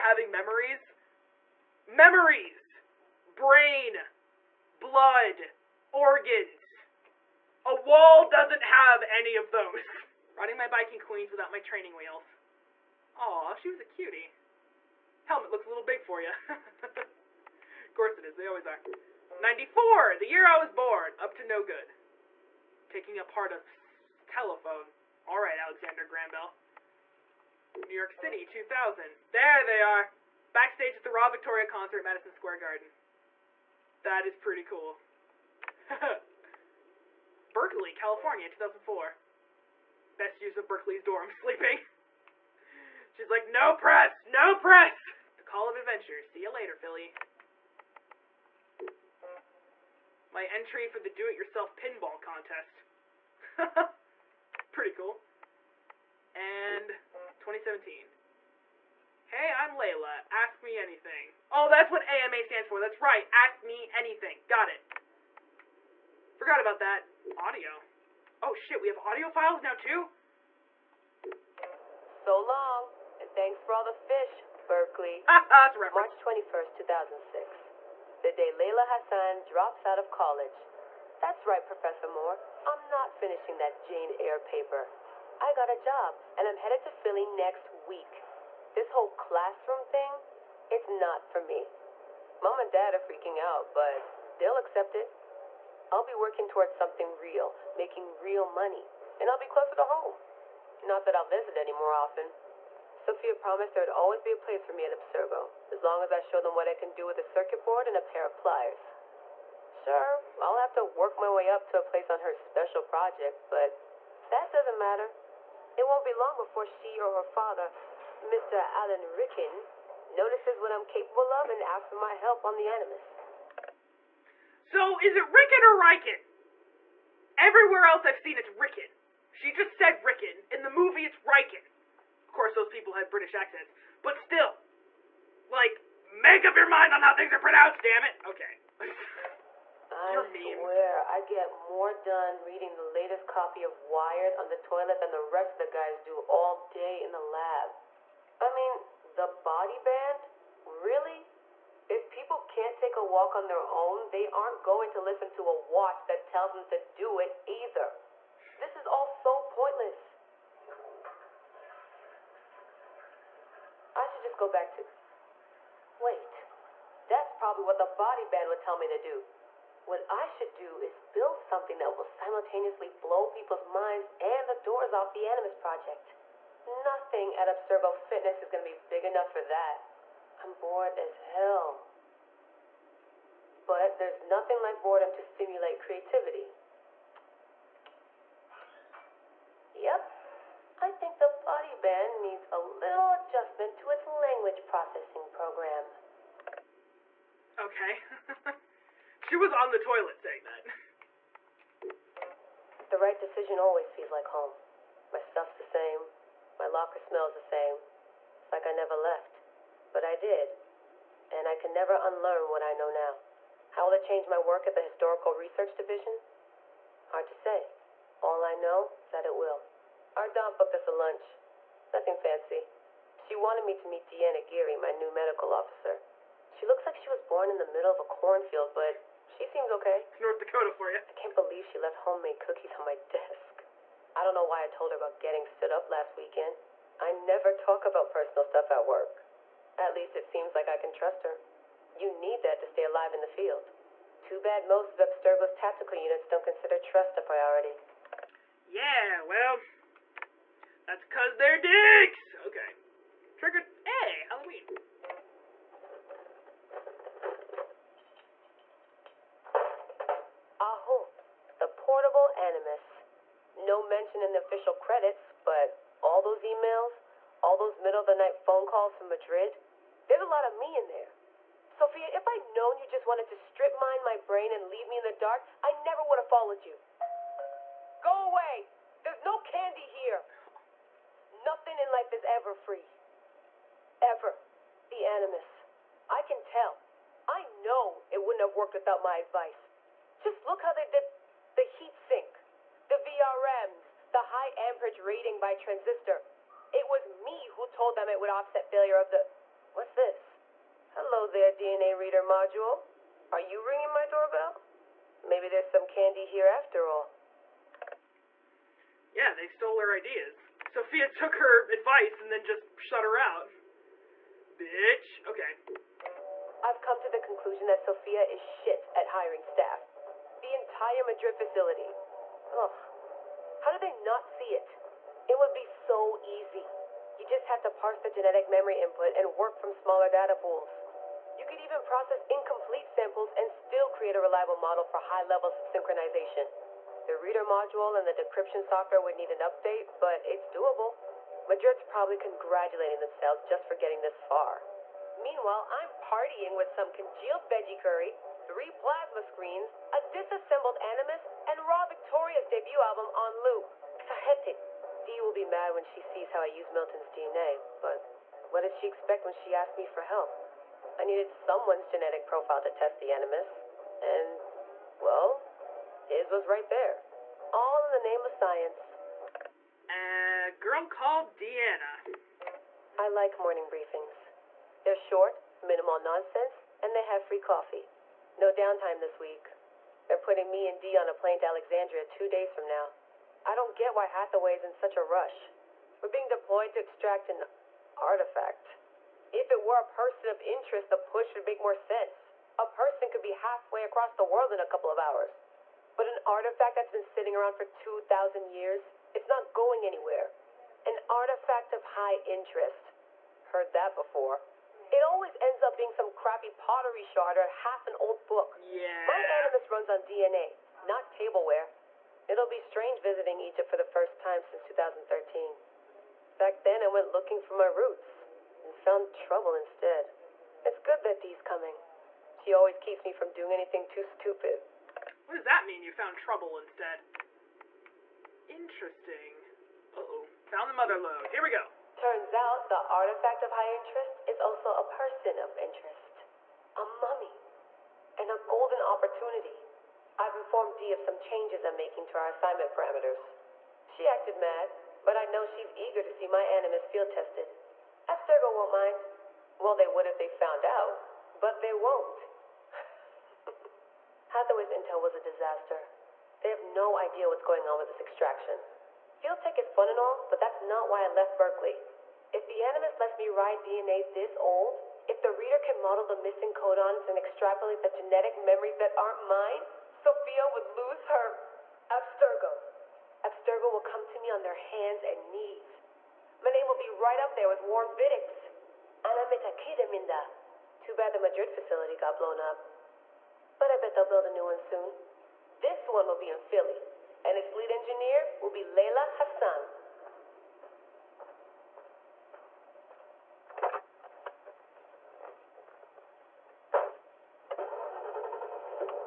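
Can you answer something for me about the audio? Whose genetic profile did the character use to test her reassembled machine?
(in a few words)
Milton.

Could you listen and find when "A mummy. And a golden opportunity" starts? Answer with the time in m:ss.
7:16.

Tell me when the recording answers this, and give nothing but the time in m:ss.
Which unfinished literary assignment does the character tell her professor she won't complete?
1:23.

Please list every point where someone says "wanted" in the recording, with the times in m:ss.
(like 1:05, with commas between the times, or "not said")
3:43, 4:33.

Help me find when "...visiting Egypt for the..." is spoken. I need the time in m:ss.
6:53.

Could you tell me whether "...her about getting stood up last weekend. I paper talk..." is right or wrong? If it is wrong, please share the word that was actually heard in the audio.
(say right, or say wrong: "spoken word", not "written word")
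wrong: "never", not "paper".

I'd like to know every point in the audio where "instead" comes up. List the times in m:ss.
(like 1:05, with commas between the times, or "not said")
6:59, 7:06.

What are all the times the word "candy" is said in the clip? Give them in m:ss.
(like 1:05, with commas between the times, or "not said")
4:39, 5:05.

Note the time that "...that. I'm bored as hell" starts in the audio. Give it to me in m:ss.
2:59.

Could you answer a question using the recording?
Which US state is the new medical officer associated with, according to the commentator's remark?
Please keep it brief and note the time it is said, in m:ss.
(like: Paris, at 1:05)
North Dakota, at 3:50.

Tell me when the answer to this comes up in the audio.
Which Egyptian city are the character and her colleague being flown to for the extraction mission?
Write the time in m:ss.
6:21.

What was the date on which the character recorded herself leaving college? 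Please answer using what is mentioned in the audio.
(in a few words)
March 21st, 2006.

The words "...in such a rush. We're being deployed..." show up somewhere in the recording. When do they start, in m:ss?
6:24.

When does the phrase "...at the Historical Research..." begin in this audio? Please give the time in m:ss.
3:34.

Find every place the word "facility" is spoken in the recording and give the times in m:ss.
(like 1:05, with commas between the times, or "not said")
5:21, 8:01.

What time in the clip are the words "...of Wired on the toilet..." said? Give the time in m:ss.
2:23.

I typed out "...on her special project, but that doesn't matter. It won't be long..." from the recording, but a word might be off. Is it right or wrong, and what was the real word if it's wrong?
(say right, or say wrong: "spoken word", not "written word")
right.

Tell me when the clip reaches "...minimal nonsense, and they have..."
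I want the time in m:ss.
6:15.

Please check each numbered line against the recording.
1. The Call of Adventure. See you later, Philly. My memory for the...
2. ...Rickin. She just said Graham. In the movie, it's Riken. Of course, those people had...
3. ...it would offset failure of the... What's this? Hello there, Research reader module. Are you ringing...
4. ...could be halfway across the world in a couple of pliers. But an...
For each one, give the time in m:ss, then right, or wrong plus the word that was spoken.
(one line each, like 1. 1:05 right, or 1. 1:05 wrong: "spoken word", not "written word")
1. 0:45 wrong: "entry", not "memory"
2. 2:08 wrong: "Rickin", not "Graham"
3. 4:58 wrong: "DNA", not "Research"
4. 6:33 wrong: "hours", not "pliers".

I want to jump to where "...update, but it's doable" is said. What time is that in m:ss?
5:39.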